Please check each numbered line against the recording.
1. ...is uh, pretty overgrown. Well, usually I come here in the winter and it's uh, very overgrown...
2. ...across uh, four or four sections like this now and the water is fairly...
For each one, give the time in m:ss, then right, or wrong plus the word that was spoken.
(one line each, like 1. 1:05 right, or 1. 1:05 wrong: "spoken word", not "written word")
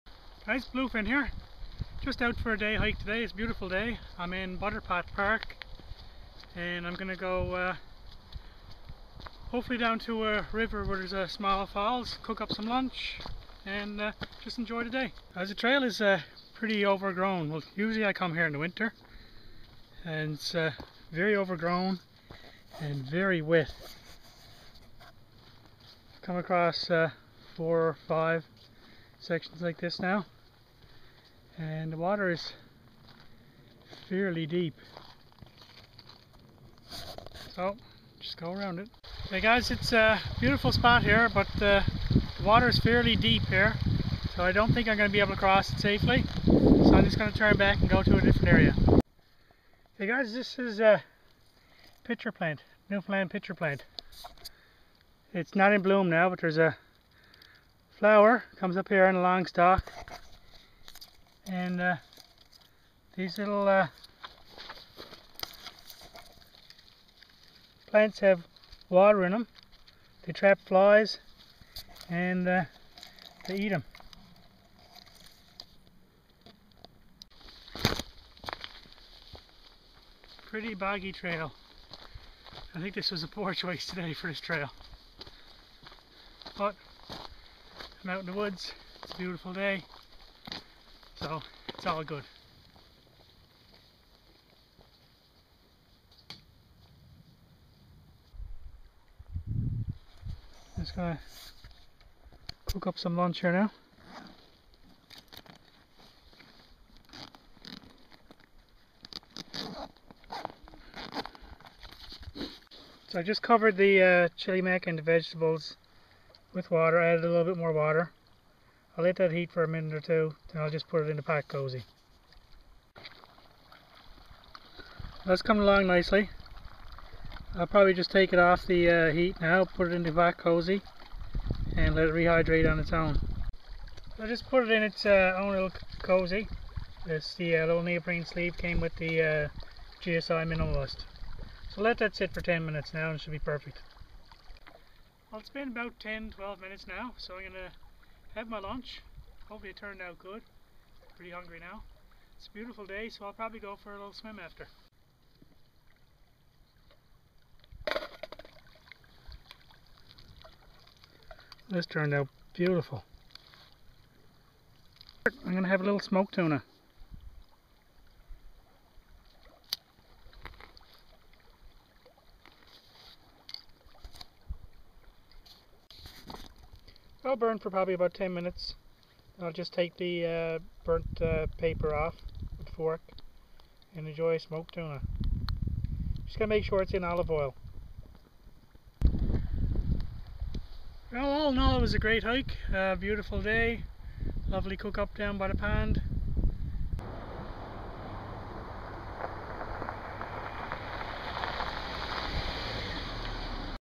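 1. 0:15 right
2. 0:26 wrong: "five", not "four".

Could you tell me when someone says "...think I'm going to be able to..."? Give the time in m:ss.
0:44.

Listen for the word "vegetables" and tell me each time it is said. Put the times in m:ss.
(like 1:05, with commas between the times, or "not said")
1:55.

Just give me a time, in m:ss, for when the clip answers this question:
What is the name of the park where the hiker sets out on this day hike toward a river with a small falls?
0:04.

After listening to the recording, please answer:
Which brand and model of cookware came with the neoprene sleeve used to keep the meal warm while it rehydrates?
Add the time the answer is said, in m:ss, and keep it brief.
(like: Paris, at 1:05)
GSI Minimalist, at 2:20.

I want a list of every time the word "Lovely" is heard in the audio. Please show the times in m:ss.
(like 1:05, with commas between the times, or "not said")
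3:14.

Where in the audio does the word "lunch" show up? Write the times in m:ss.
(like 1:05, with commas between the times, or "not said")
0:12, 1:43, 2:28.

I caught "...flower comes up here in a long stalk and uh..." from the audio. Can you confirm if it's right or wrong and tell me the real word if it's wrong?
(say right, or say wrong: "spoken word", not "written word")
right.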